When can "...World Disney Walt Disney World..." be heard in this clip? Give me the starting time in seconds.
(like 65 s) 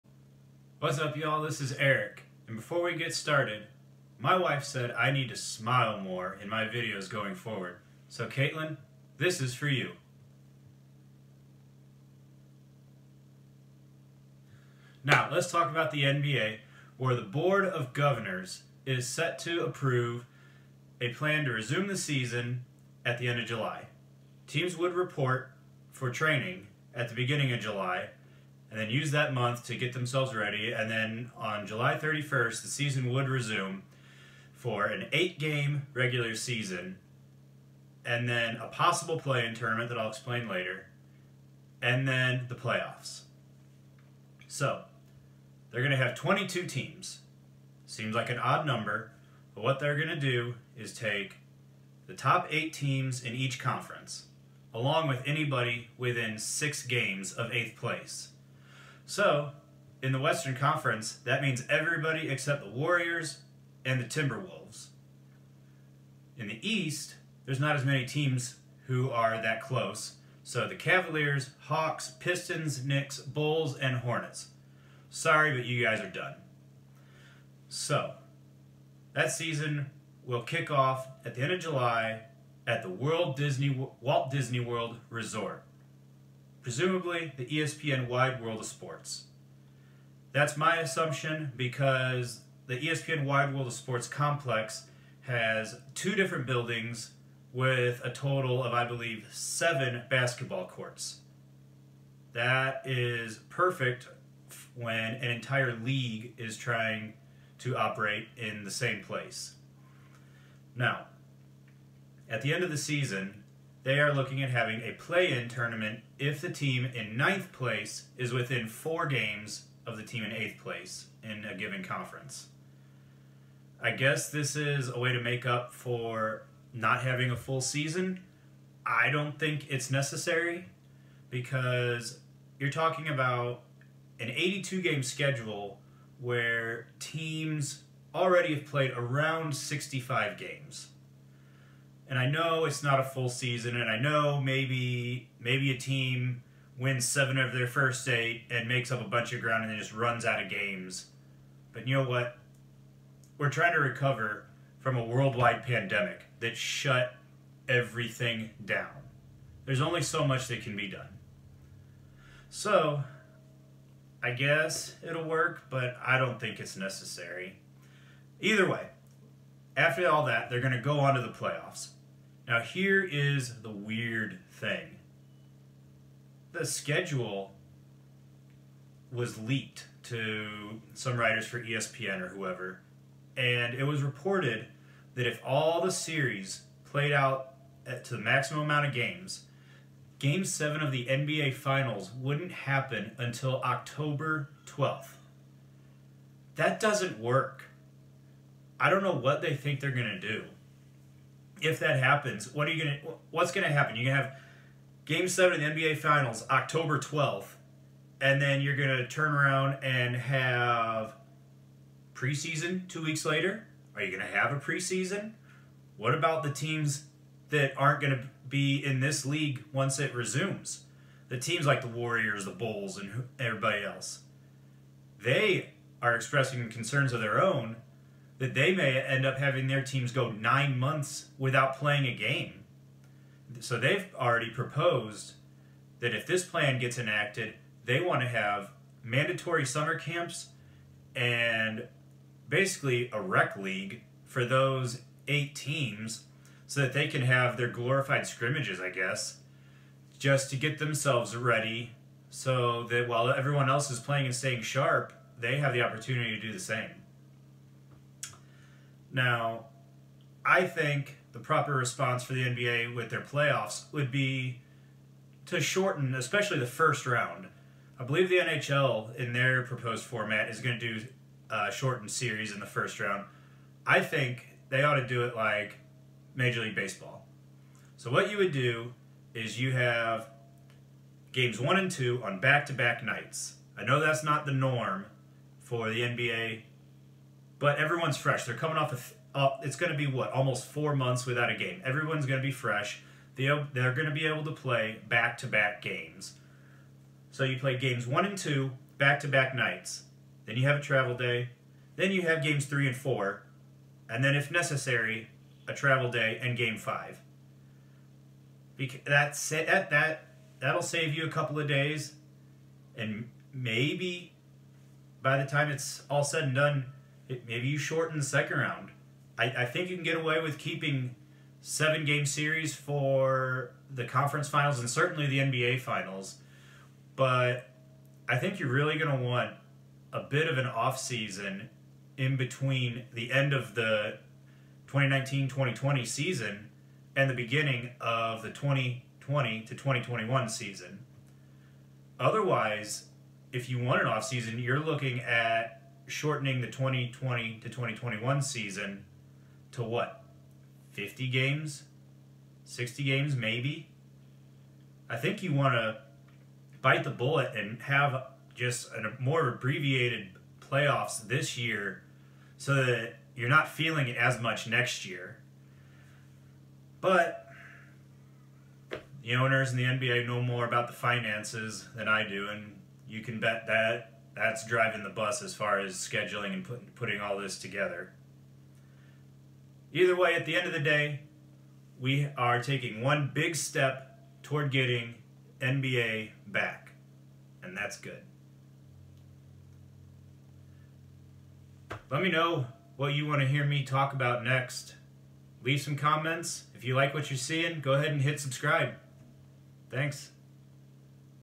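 82 s.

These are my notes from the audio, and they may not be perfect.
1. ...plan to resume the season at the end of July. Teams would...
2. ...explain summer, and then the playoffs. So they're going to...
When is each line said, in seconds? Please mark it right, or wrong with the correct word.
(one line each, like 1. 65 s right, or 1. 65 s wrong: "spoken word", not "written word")
1. 21 s right
2. 40 s wrong: "later", not "summer".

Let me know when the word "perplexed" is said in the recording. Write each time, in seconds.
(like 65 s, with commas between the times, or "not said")
not said.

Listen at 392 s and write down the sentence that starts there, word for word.
Let me know what you want to hear me talk about next.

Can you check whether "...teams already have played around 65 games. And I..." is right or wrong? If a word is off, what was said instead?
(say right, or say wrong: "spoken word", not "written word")
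right.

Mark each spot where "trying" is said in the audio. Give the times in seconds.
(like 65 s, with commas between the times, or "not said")
106 s, 153 s.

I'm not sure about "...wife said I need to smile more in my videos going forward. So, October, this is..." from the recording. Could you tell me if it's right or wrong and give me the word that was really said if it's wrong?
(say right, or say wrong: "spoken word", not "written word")
wrong: "Caitlin", not "October".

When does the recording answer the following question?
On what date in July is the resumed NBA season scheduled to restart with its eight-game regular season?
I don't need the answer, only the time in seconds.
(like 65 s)
31 s.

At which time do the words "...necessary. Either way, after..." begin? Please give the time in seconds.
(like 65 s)
166 s.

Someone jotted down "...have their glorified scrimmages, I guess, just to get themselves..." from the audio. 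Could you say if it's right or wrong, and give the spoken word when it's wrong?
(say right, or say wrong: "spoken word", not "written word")
right.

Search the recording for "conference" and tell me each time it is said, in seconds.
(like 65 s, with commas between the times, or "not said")
53 s, 60 s, 121 s, 324 s.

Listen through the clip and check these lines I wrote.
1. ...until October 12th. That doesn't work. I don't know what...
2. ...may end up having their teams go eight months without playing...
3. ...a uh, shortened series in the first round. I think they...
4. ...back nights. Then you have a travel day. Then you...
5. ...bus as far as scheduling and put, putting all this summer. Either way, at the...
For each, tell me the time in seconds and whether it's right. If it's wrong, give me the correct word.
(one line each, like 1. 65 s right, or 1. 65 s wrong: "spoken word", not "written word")
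1. 193 s right
2. 228 s wrong: "nine", not "eight"
3. 271 s right
4. 299 s right
5. 375 s wrong: "together", not "summer".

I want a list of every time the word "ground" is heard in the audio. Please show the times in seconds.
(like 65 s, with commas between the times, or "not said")
149 s.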